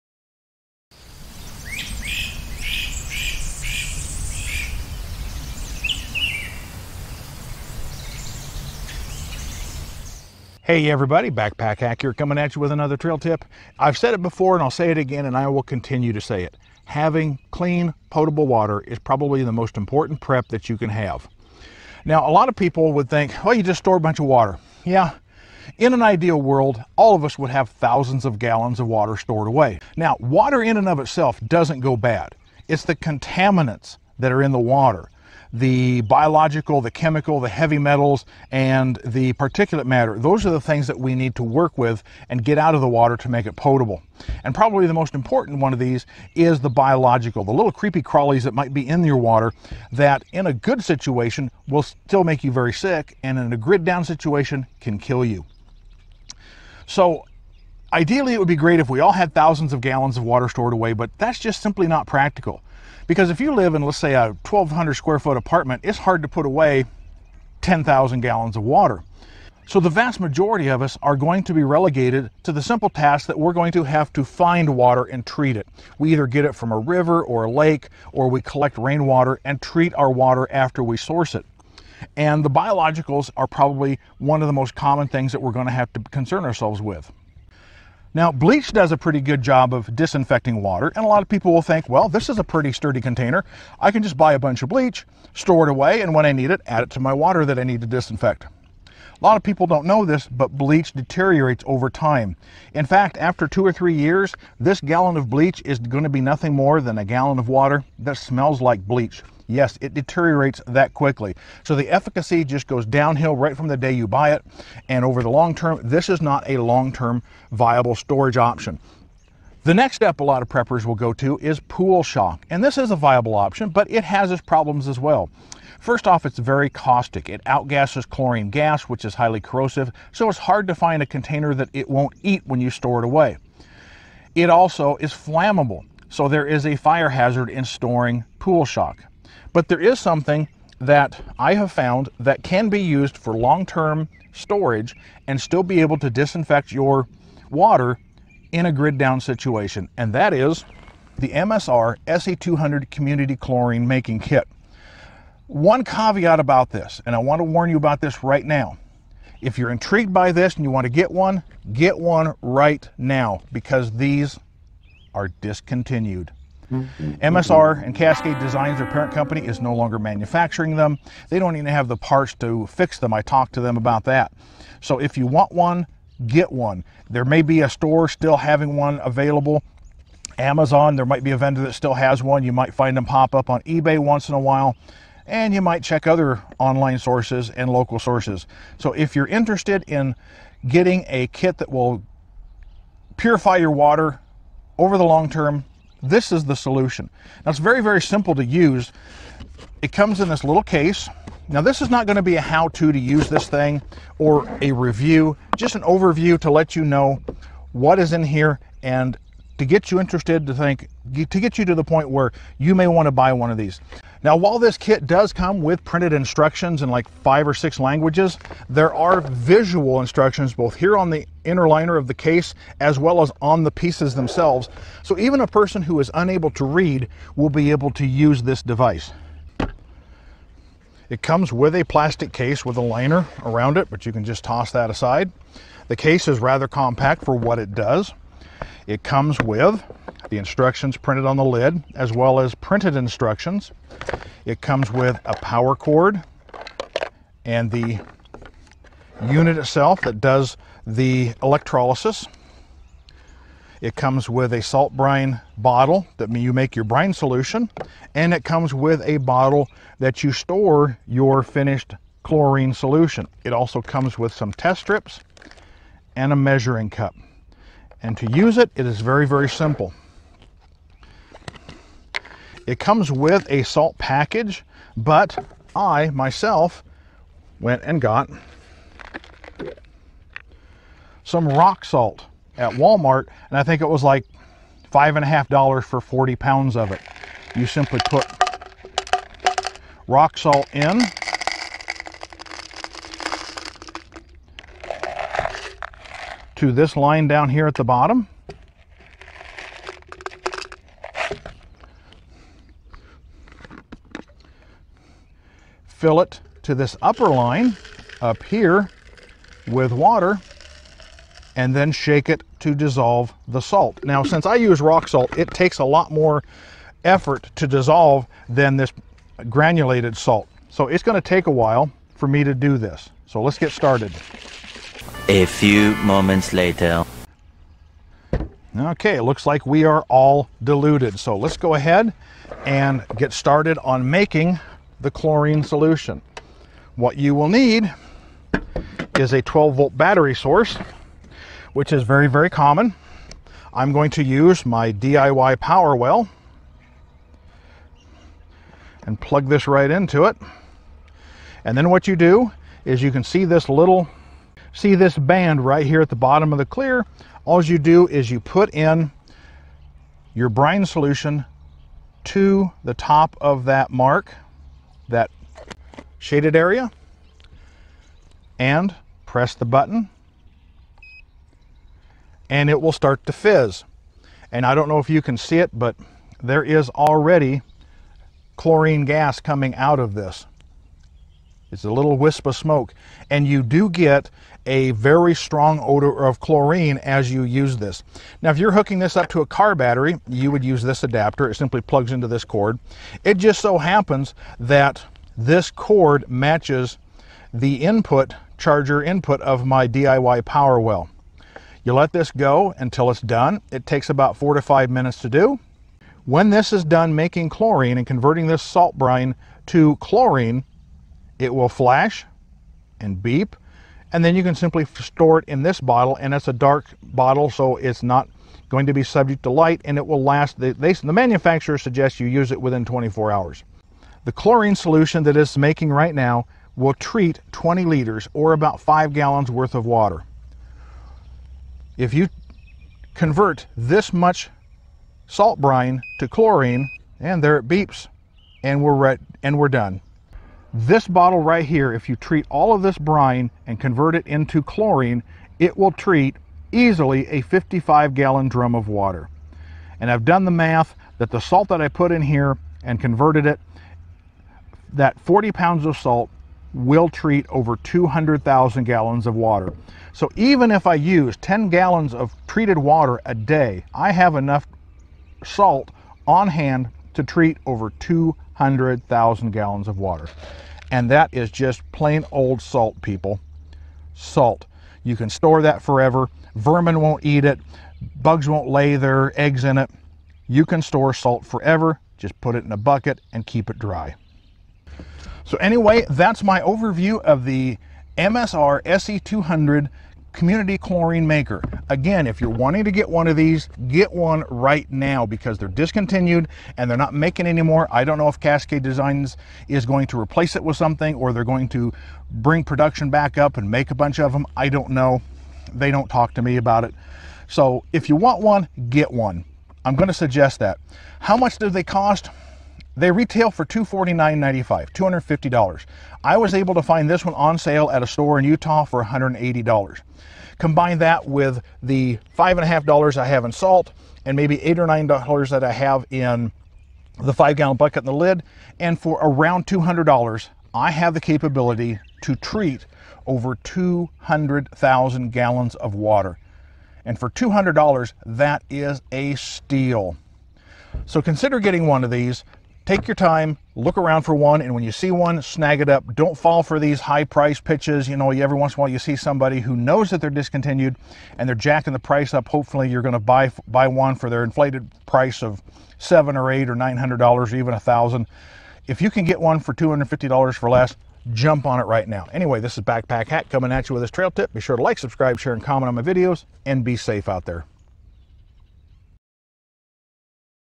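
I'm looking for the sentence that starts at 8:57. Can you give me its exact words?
And for $200, that is a steal.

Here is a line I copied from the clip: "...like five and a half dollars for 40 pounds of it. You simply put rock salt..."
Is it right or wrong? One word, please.
right.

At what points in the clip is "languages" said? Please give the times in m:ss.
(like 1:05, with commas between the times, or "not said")
3:37.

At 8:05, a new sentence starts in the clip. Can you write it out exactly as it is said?
So anyway, that's my overview of the MSR SE200 community chlorine maker.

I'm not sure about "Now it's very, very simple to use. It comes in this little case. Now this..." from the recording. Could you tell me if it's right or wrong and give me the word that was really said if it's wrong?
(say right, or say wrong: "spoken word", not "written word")
right.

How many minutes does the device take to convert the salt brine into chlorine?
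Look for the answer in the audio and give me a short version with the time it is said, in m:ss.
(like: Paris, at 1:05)
4 to 5 minutes, at 6:44.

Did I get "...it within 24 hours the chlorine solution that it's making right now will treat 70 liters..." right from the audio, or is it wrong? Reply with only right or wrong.
wrong.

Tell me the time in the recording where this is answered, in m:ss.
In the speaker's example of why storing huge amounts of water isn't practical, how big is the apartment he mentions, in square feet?
1:04.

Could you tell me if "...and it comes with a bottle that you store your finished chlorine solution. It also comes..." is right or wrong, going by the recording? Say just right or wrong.
right.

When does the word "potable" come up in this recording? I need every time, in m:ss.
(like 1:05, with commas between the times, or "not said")
0:18, 0:43.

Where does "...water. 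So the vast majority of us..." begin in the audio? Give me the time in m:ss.
1:08.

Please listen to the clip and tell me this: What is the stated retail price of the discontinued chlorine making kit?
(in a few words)
$249.95.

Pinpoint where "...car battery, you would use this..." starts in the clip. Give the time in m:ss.
6:29.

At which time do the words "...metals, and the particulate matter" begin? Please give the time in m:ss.
0:37.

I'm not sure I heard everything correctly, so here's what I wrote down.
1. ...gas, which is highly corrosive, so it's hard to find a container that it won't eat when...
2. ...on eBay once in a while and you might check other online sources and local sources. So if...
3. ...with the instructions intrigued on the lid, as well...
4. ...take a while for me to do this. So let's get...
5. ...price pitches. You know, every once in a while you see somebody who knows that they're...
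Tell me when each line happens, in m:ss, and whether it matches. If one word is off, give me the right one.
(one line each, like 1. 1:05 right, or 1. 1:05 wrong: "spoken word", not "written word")
1. 2:08 right
2. 3:03 right
3. 3:59 wrong: "printed", not "intrigued"
4. 5:21 right
5. 9:07 right.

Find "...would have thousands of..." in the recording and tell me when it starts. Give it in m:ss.
0:27.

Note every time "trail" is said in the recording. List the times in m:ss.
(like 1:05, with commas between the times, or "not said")
0:12, 9:24.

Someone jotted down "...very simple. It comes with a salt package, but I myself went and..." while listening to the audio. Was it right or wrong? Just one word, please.
right.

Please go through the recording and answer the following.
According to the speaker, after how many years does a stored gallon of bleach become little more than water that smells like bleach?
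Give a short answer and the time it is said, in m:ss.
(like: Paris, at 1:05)
2 or 3, at 1:43.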